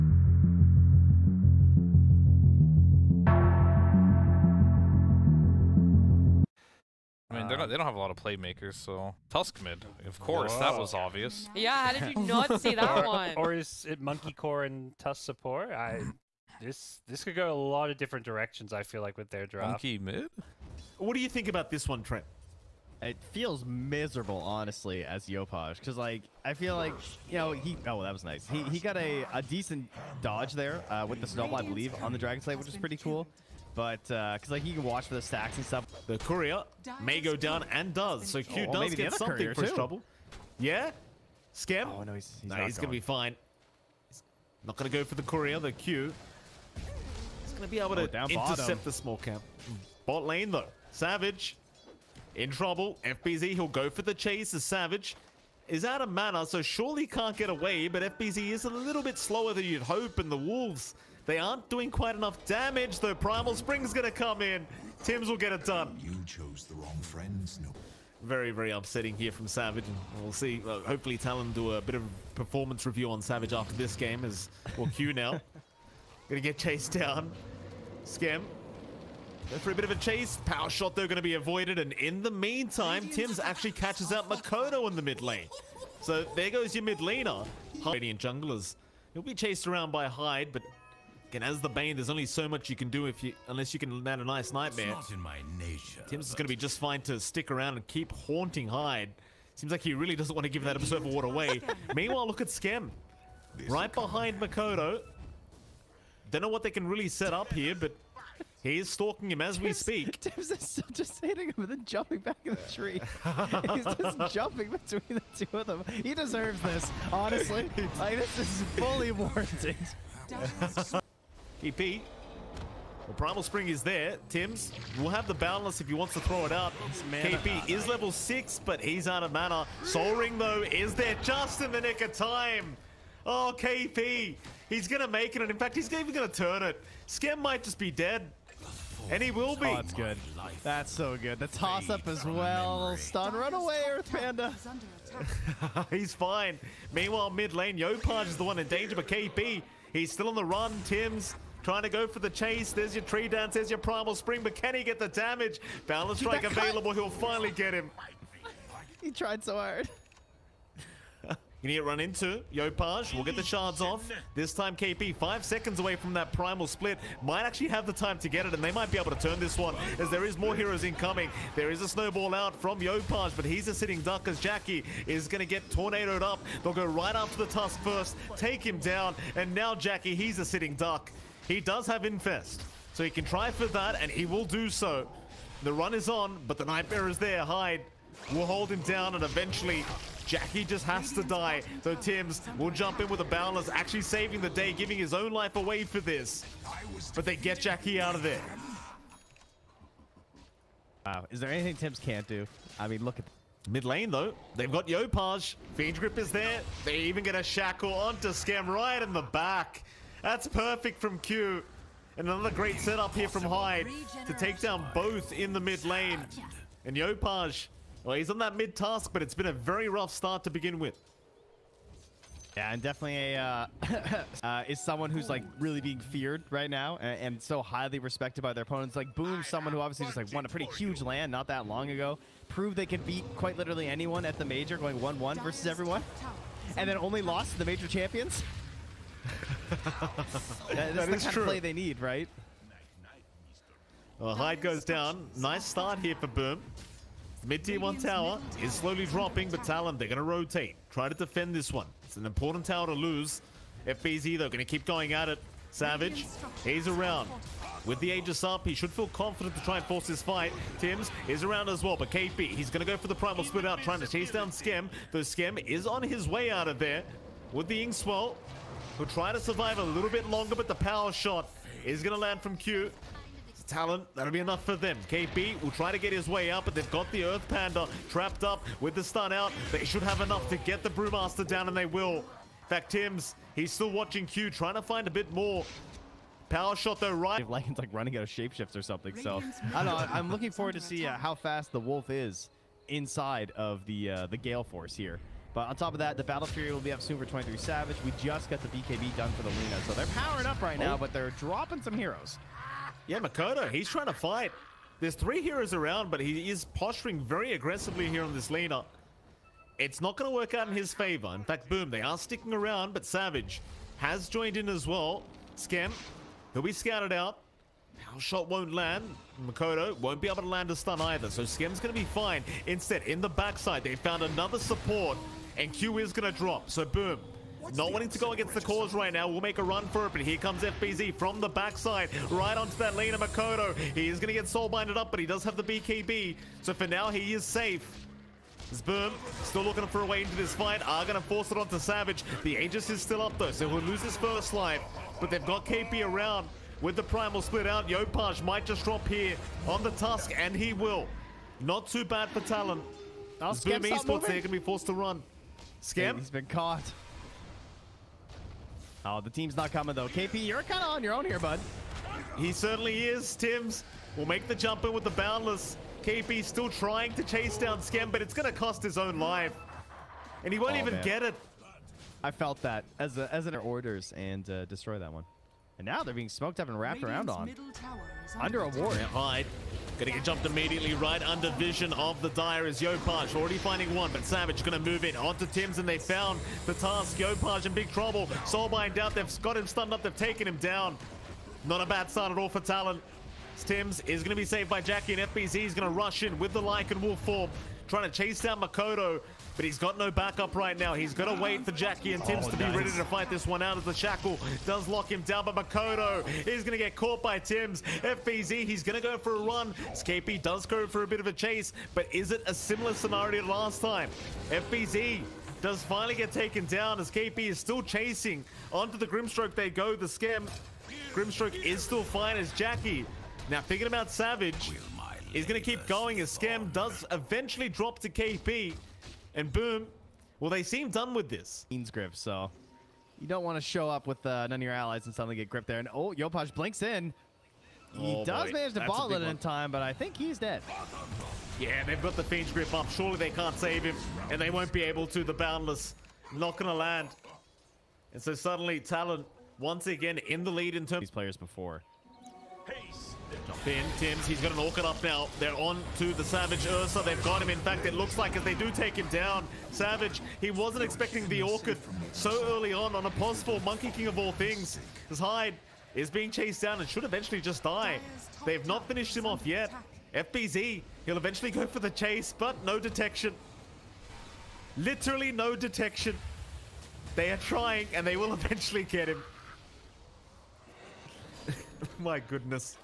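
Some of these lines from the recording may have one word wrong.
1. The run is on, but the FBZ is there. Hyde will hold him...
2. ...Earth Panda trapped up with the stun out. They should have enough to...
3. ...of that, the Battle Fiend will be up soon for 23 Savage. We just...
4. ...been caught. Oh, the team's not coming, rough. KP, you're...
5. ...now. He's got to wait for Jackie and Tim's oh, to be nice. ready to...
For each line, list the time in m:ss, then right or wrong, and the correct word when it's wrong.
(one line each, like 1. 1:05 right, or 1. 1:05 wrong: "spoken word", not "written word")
1. 3:05 wrong: "Nightmare", not "FBZ"
2. 4:37 right
3. 4:55 wrong: "Fury", not "Fiend"
4. 5:56 wrong: "though", not "rough"
5. 6:40 right.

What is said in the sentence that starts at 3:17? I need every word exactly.
But they get Jackie out of there.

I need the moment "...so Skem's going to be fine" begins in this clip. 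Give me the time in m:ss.
5:21.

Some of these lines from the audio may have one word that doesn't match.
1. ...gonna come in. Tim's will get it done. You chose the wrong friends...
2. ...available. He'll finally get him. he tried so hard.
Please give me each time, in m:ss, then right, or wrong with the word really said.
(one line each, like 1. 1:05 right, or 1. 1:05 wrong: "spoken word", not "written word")
1. 1:03 right
2. 2:36 right.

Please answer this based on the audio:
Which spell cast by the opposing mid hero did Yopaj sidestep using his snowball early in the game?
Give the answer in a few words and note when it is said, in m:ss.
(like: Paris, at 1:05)
Dragon Slave, at 0:32.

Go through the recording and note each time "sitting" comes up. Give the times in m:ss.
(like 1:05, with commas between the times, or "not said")
2:53, 3:00.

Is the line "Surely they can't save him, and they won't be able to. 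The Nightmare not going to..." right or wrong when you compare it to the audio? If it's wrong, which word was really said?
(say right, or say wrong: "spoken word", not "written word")
wrong: "Boundless", not "Nightmare".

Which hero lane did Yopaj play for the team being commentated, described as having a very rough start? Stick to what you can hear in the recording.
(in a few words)
mid Tusk.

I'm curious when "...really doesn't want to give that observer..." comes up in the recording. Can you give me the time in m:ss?
1:39.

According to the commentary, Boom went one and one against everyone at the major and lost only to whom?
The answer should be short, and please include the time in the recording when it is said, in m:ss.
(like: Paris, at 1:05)
the major champions, at 3:57.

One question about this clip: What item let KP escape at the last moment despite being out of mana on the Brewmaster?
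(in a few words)
Soul Ring.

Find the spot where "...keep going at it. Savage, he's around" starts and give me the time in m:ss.
4:14.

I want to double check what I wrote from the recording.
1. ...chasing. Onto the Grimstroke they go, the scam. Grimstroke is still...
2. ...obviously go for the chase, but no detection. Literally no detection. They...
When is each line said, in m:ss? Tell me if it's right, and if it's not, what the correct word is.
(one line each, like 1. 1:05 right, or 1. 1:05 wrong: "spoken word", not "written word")
1. 6:57 right
2. 7:51 wrong: "eventually", not "obviously".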